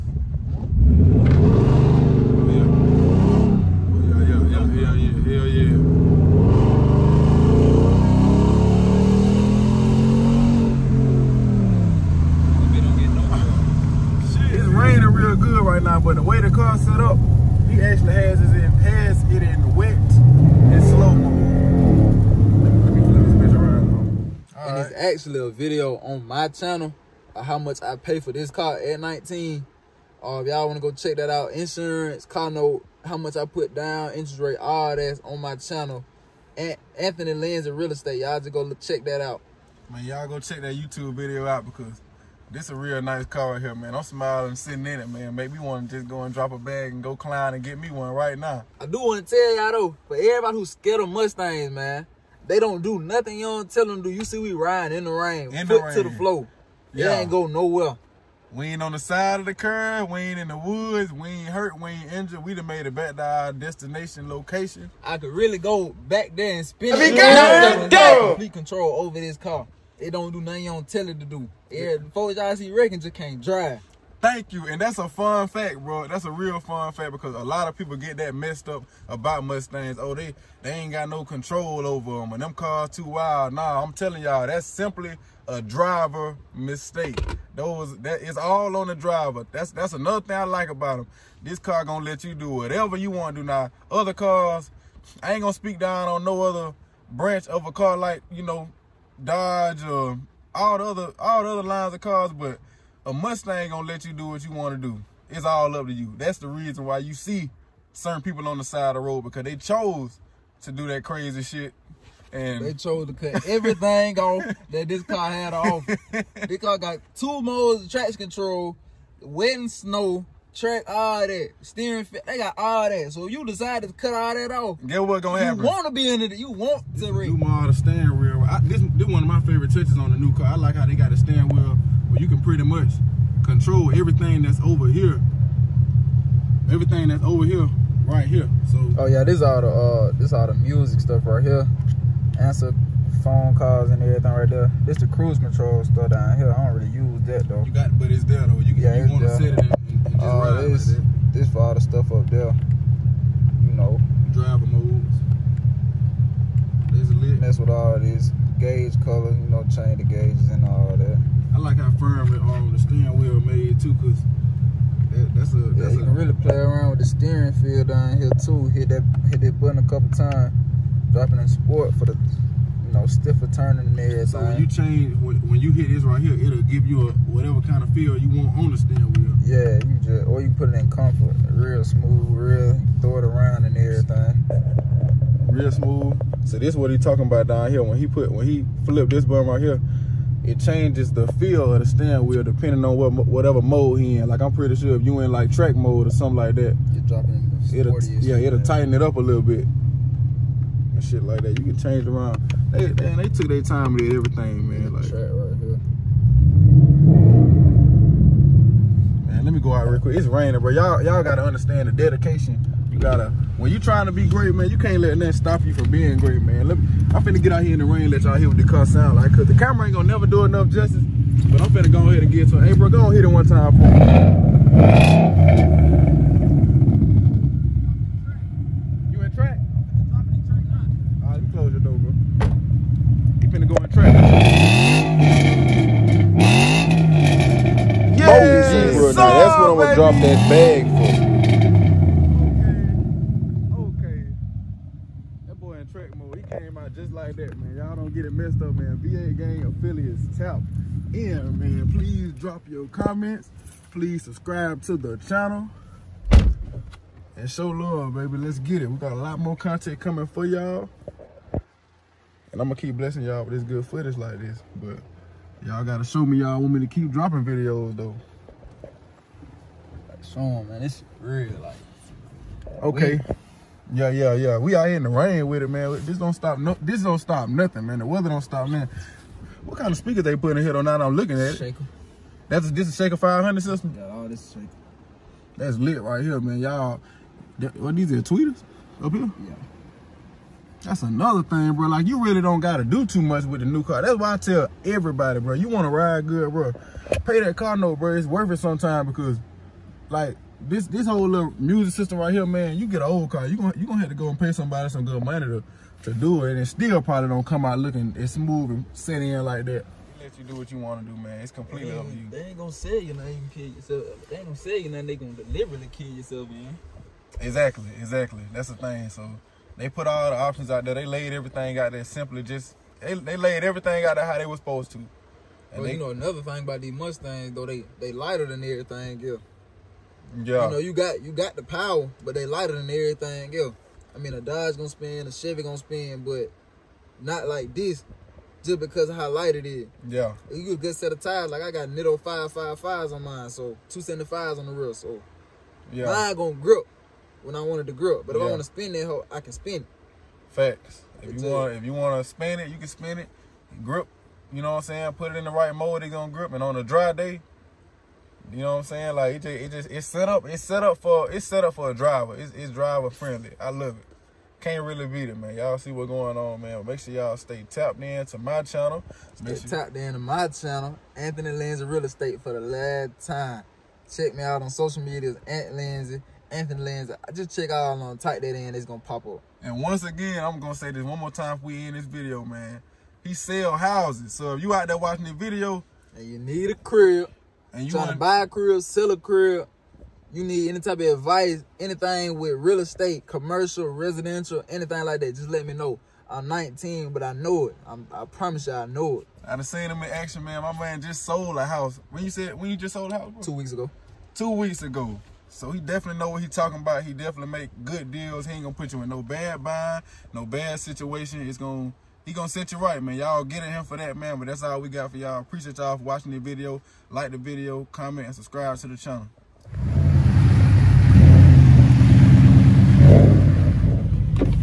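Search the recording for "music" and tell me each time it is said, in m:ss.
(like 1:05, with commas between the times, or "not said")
2:20, 5:01.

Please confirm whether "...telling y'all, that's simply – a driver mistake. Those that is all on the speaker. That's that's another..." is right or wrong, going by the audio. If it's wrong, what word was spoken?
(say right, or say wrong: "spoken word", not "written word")
wrong: "driver", not "speaker".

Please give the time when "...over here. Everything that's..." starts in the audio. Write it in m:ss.
2:14.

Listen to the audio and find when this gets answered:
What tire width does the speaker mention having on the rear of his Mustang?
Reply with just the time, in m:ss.
5:43.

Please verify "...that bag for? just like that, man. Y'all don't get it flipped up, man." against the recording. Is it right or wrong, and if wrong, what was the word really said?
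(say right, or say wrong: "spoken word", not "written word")
wrong: "messed", not "flipped".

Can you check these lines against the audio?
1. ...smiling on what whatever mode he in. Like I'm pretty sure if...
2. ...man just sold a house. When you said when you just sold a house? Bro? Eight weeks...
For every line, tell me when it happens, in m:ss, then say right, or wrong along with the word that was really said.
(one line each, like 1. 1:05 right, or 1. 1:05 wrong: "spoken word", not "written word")
1. 3:12 wrong: "depending", not "smiling"
2. 6:40 wrong: "Two", not "Eight".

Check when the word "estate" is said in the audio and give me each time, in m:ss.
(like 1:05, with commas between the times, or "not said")
0:37, 6:12, 6:32.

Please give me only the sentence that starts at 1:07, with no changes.
got complete control over this car.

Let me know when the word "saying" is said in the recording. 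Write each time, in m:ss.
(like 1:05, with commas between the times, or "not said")
5:54, 5:58.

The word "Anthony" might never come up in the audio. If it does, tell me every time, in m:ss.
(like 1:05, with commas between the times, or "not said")
0:36, 6:11, 6:16.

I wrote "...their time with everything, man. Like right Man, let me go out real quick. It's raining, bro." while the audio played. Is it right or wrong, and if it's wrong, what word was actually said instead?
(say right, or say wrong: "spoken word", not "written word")
right.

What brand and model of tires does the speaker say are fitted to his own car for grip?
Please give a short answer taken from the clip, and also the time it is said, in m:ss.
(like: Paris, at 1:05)
Nitto 555, at 5:41.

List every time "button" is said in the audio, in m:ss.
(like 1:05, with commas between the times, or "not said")
2:49, 3:09.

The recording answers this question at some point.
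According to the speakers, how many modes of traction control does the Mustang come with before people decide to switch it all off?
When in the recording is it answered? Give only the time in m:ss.
1:57.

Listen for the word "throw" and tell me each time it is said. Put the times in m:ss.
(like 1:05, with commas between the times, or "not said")
3:03.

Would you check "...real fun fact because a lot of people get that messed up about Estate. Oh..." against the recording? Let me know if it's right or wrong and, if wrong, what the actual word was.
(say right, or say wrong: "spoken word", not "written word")
wrong: "Mustangs", not "Estate".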